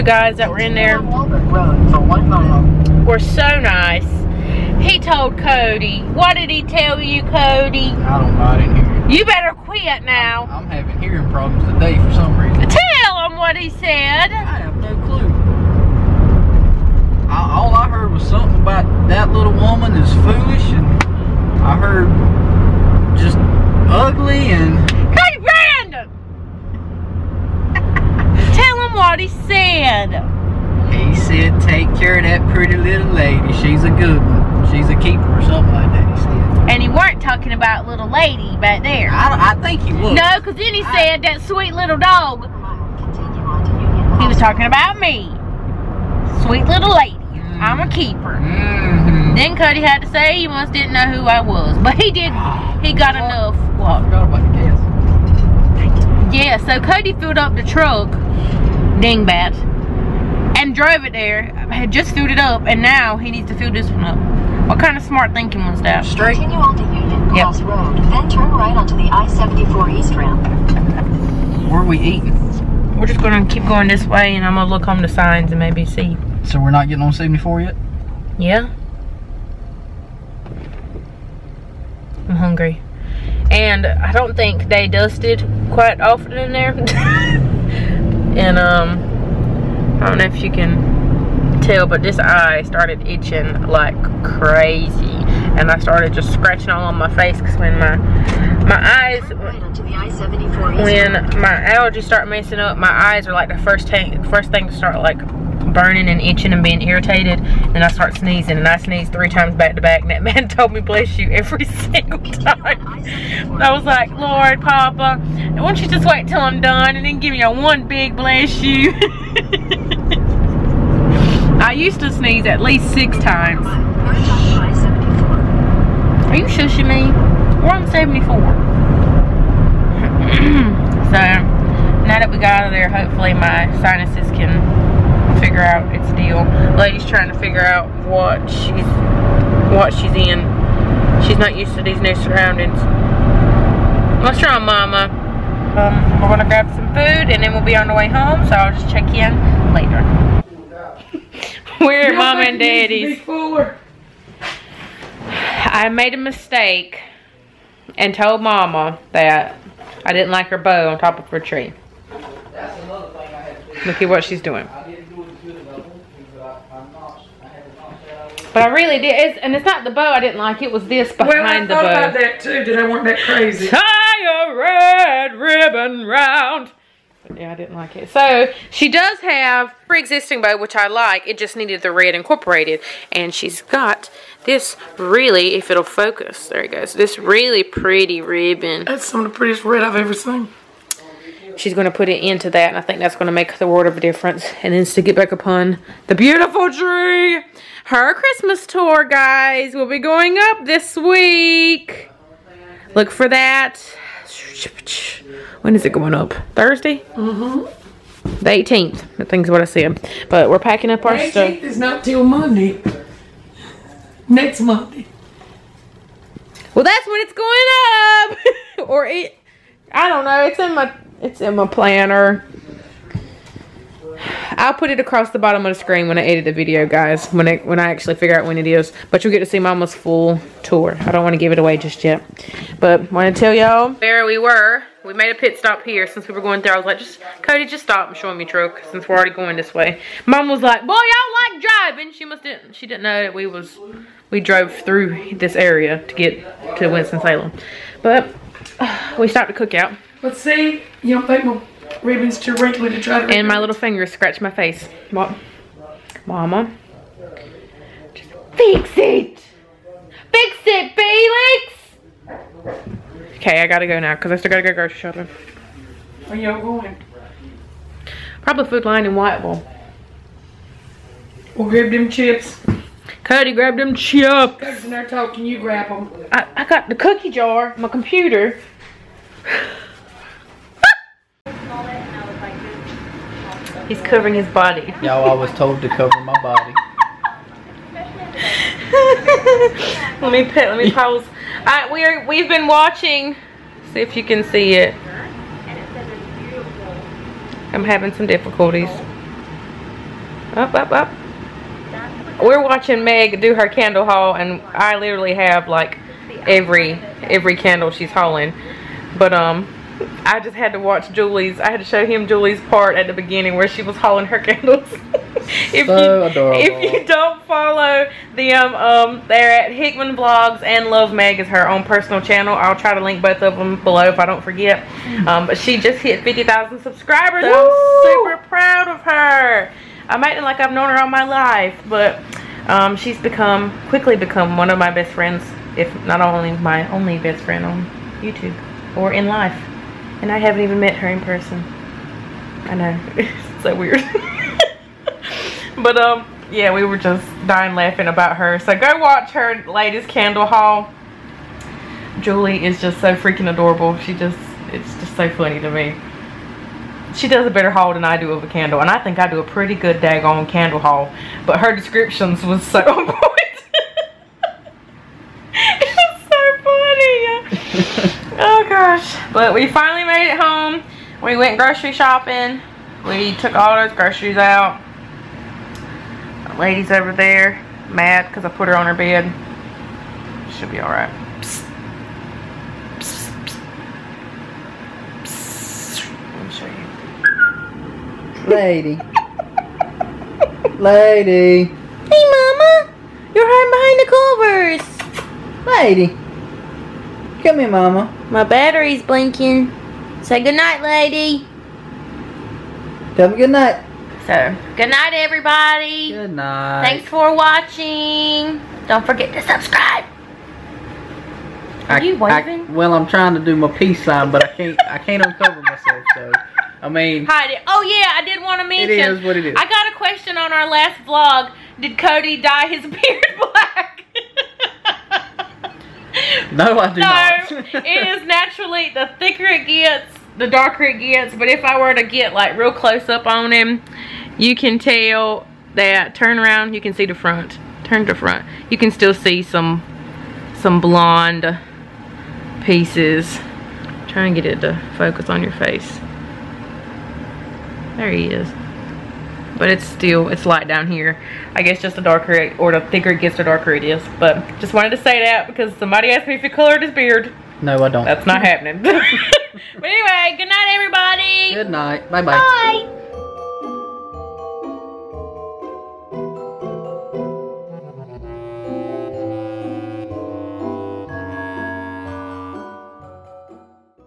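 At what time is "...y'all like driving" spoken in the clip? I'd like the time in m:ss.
4:00.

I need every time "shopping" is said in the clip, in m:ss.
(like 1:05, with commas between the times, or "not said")
4:24, 6:11.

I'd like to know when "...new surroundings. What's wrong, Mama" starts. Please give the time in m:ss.
2:21.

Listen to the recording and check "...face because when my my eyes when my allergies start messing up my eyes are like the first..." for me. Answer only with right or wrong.
right.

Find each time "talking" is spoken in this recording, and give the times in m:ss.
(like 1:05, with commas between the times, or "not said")
0:37, 0:44, 4:35.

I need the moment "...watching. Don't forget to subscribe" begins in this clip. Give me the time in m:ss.
6:47.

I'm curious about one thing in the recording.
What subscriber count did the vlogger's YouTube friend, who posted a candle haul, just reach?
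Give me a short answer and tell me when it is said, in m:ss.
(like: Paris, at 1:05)
50,000, at 5:26.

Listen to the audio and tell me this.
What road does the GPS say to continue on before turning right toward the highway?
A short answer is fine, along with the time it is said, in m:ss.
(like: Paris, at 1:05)
Union Cross Road, at 1:06.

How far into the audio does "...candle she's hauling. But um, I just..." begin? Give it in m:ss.
5:07.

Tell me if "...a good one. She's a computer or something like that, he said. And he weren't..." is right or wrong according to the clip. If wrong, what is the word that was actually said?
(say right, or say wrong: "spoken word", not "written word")
wrong: "keeper", not "computer".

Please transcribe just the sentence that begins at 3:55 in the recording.
We made a pit stop here since we were going there.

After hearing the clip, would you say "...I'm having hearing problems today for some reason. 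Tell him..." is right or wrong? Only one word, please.
right.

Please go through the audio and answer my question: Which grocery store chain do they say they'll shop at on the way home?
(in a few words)
Food Lion.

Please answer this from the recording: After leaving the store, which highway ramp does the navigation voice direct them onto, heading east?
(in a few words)
I-74.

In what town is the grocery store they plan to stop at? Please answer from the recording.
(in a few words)
Whiteville.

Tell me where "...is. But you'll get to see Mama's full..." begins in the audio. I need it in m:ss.
3:48.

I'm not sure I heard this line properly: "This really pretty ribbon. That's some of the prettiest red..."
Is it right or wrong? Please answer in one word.
right.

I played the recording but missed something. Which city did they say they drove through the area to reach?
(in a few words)
Winston Salem.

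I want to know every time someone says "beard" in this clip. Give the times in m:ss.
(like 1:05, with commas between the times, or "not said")
7:02, 7:36.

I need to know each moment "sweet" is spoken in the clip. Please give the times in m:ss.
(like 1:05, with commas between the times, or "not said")
0:41, 0:46.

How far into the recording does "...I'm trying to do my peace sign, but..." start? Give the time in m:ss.
6:52.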